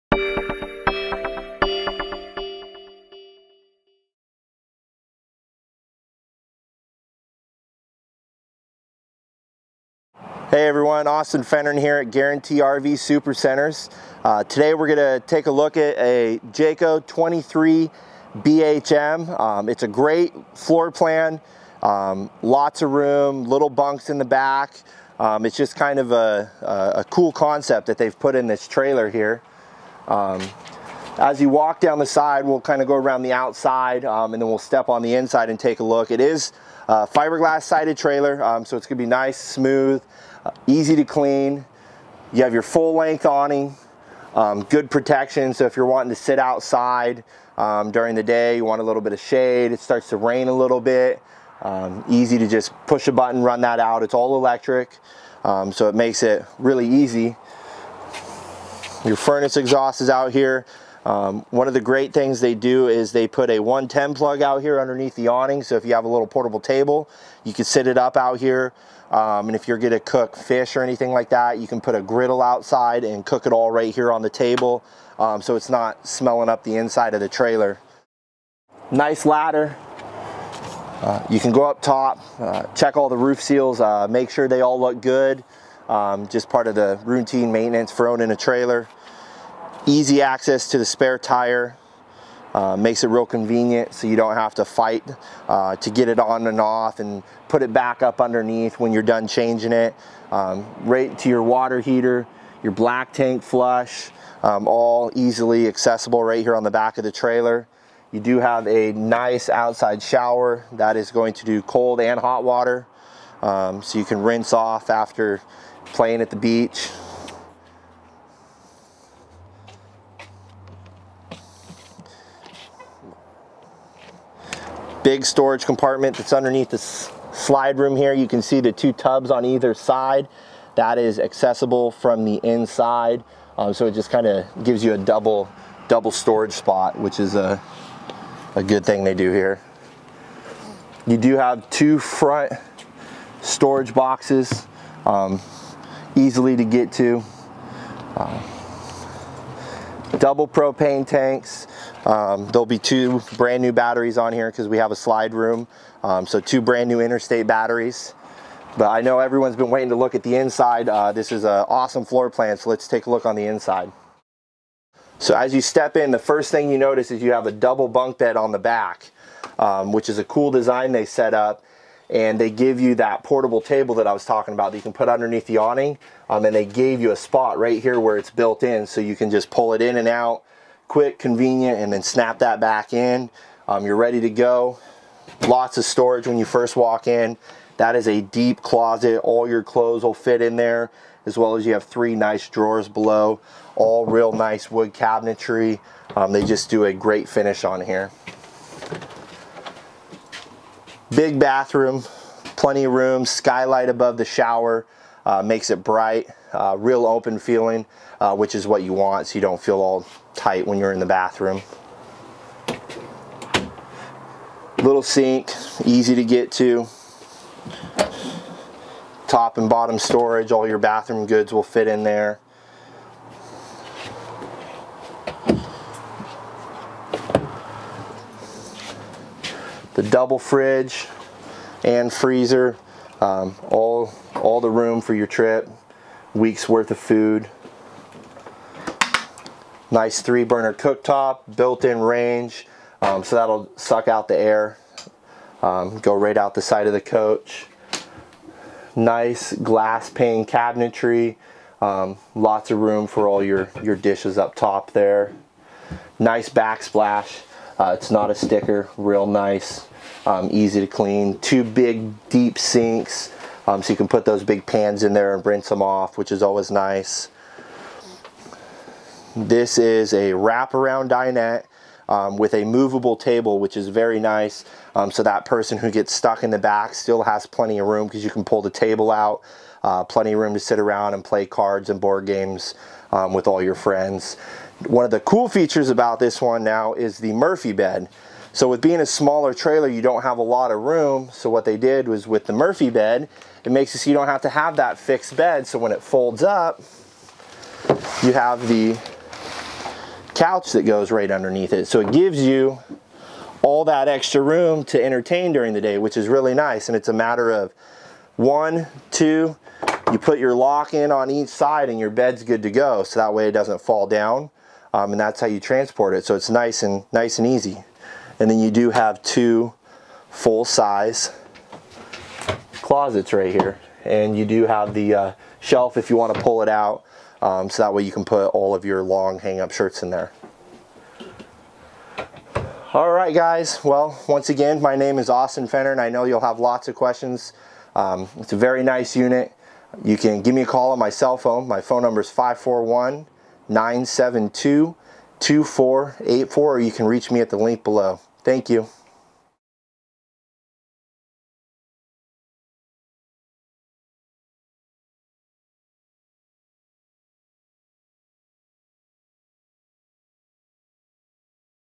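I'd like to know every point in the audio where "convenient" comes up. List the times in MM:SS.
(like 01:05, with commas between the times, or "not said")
01:33, 03:01.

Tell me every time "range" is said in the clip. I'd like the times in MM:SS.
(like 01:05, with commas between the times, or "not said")
04:01.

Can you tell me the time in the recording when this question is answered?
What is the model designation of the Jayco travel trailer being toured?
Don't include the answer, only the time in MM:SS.
00:17.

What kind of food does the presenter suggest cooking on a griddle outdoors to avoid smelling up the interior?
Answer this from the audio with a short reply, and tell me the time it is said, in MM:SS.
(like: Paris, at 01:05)
Fish, at 01:10.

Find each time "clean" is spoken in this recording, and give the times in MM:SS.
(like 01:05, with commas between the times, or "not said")
00:41, 04:20.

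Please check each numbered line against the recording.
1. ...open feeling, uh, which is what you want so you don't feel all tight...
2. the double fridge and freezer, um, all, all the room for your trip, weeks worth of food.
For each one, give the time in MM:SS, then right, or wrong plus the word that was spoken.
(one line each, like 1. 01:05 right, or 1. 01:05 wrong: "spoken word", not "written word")
1. 03:27 right
2. 03:50 right.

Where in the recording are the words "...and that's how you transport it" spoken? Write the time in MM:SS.
05:15.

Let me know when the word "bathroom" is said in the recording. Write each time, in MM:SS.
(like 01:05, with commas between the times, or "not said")
03:21, 03:31, 03:40.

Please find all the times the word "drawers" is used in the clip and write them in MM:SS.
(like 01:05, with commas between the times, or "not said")
03:12.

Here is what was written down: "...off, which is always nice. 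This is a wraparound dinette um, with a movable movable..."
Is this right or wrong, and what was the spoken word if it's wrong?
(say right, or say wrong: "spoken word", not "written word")
wrong: "table", not "movable".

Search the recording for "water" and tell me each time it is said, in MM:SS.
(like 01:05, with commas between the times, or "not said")
01:41, 01:52.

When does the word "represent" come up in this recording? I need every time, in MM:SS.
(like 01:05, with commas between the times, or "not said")
not said.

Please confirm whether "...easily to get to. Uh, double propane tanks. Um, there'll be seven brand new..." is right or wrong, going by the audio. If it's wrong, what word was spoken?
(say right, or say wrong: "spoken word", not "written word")
wrong: "two", not "seven".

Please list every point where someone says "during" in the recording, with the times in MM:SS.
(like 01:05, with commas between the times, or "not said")
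00:47, 05:05.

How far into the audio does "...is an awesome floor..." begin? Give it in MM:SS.
02:41.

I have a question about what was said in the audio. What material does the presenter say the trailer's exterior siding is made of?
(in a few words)
Fiberglass.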